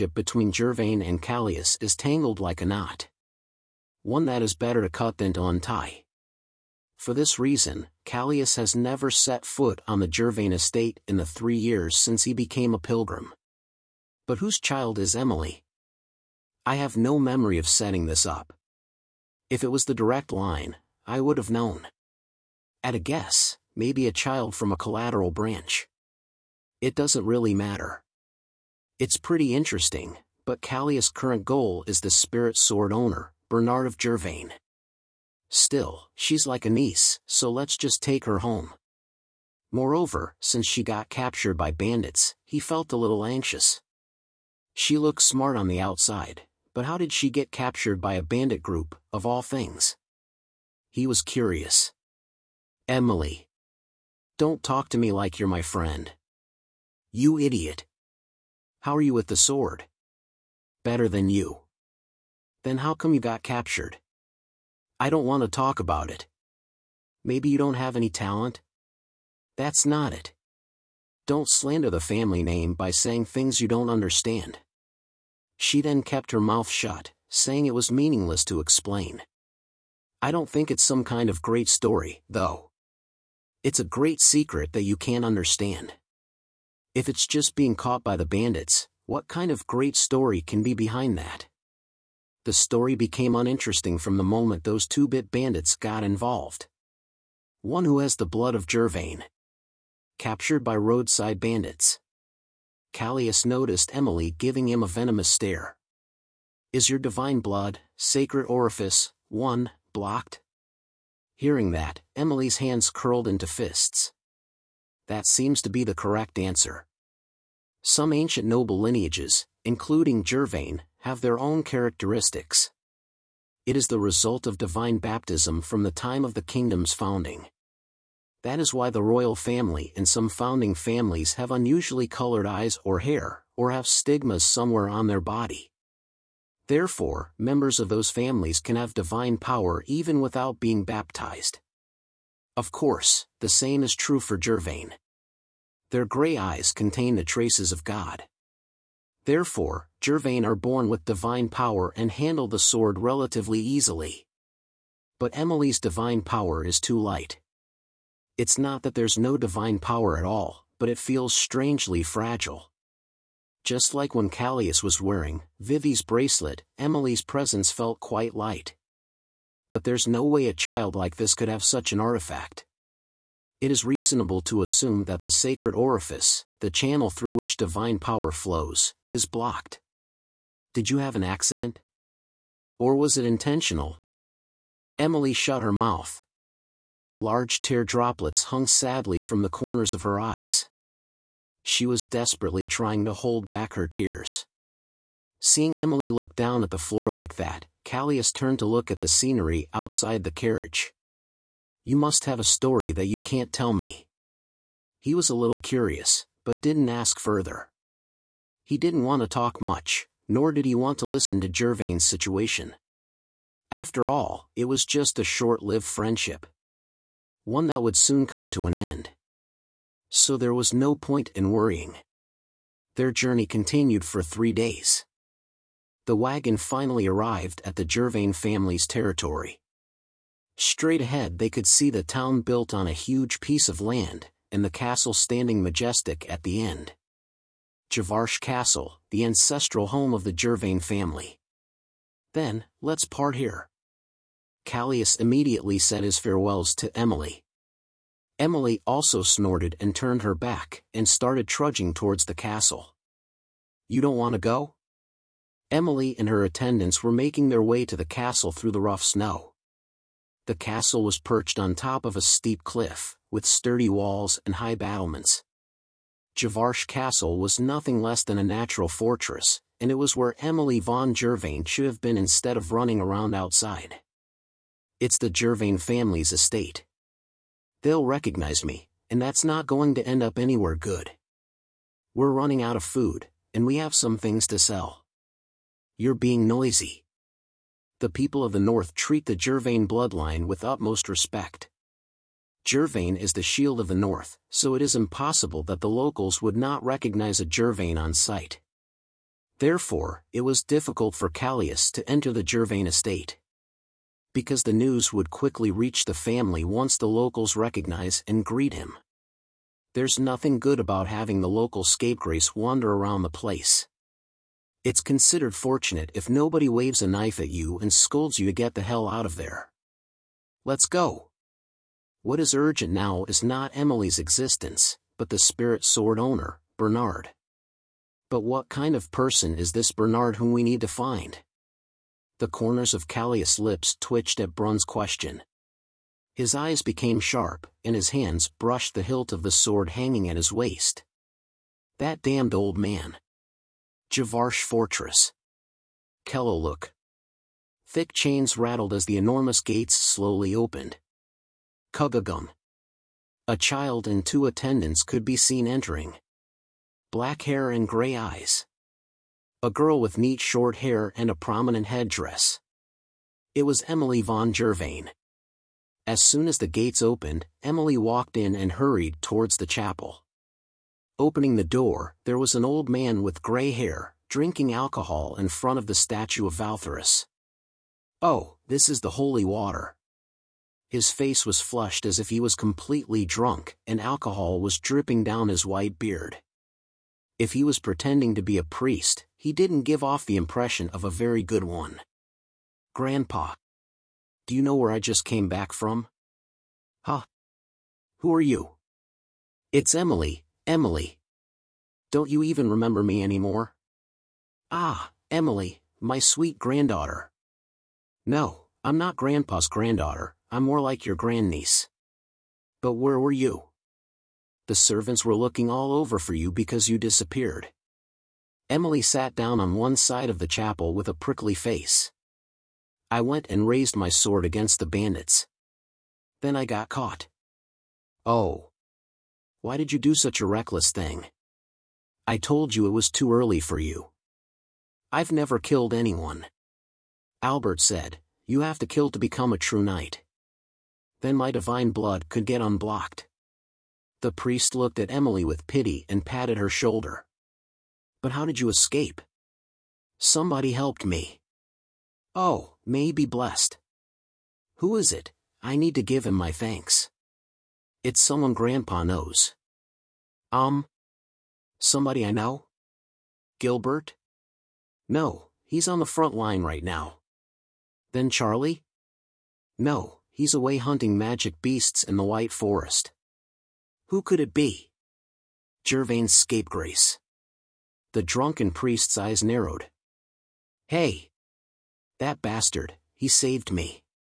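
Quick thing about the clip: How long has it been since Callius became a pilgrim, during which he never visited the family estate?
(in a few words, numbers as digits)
3 years.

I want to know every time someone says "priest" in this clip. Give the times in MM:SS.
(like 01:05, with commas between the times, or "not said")
06:28, 07:24, 07:58.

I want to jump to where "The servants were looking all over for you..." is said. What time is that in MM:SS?
06:54.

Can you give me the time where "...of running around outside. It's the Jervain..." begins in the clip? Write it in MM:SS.
04:32.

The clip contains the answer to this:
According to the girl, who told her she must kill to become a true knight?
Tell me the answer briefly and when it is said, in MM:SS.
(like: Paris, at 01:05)
Albert, at 07:17.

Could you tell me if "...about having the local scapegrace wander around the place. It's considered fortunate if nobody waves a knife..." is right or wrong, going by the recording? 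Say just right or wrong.
right.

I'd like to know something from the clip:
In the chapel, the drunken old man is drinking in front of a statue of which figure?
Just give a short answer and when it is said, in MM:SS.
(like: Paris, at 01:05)
Valtherus, at 06:16.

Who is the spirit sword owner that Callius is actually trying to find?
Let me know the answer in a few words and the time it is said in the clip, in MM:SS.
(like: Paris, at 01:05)
Bernard of Jervain, at 00:33.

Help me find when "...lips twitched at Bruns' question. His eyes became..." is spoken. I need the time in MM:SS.
05:33.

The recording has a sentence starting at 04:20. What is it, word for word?
The castle was perched on top of a steep cliff, with sturdy walls and high battlements.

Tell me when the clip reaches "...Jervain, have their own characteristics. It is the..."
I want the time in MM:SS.
02:00.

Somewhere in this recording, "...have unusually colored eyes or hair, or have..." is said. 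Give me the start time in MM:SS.
02:11.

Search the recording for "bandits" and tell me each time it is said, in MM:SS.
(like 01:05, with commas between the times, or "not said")
00:41, 00:48, 01:28, 01:35, 01:41, 07:04.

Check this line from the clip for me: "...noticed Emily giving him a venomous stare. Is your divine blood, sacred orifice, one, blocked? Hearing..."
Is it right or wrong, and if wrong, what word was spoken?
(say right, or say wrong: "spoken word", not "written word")
right.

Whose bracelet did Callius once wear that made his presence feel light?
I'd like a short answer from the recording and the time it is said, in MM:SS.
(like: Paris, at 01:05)
Vivi's, at 02:45.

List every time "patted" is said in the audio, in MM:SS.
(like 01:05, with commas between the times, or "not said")
07:26.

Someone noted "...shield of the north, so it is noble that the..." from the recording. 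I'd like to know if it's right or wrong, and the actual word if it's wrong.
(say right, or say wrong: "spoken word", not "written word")
wrong: "impossible", not "noble".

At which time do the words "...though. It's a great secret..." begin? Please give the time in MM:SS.
01:22.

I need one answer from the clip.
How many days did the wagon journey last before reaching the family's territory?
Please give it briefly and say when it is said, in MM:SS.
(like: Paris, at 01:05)
3 days, at 03:44.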